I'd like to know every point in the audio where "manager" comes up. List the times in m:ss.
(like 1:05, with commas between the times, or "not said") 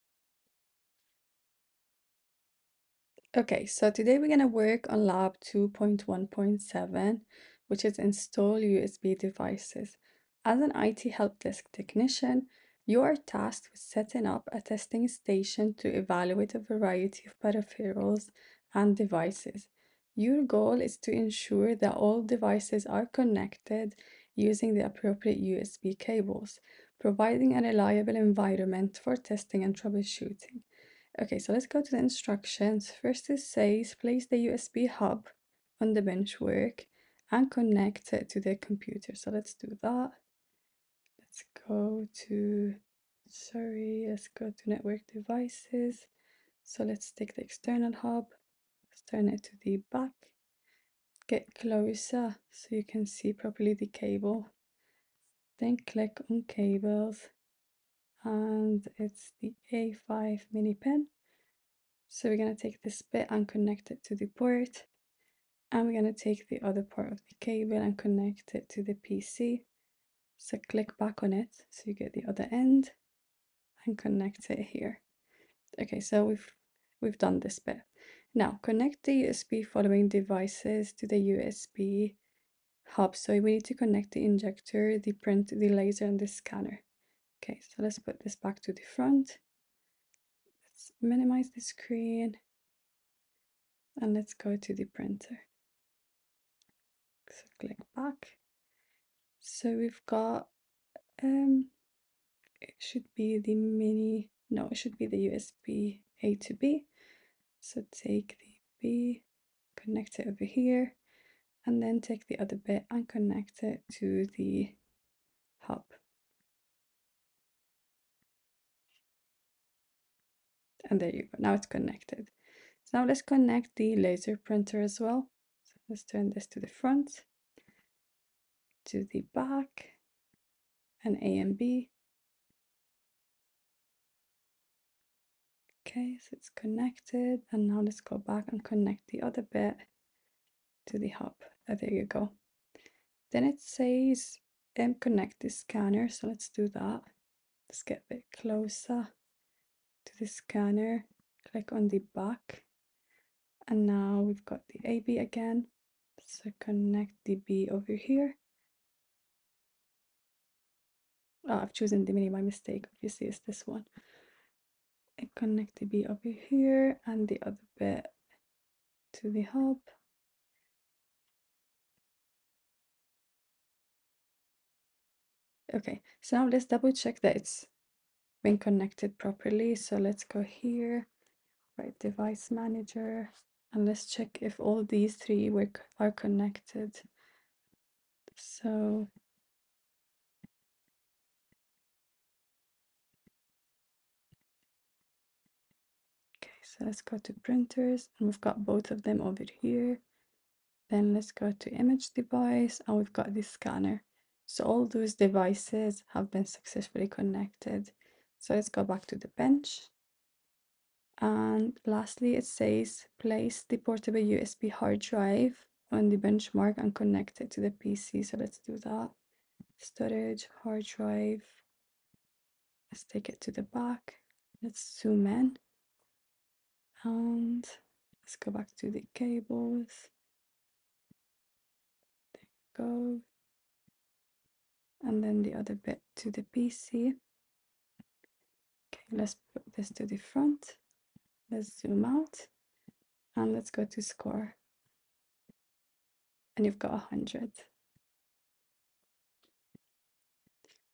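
3:02.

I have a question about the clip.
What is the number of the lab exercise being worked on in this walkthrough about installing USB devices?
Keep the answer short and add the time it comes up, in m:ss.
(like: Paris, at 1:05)
2.1.7, at 0:05.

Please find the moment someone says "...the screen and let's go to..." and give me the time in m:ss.
1:31.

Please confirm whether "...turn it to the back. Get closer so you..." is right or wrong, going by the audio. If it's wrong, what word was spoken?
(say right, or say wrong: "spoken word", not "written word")
right.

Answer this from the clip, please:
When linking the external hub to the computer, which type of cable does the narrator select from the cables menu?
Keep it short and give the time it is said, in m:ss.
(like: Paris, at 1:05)
A5 mini pin, at 0:59.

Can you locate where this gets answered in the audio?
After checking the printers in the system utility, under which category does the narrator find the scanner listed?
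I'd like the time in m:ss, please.
3:21.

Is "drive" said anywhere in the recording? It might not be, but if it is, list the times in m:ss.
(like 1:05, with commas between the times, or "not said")
3:34, 3:40.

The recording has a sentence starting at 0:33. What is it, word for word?
First it says place the USB hub on the benchwork and connect it to the computer.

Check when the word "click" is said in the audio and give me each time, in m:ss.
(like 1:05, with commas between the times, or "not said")
0:55, 1:10, 1:37, 2:31.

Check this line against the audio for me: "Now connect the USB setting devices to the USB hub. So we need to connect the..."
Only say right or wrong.
wrong.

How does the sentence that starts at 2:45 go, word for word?
I connect the B over here and the other bit to the hub.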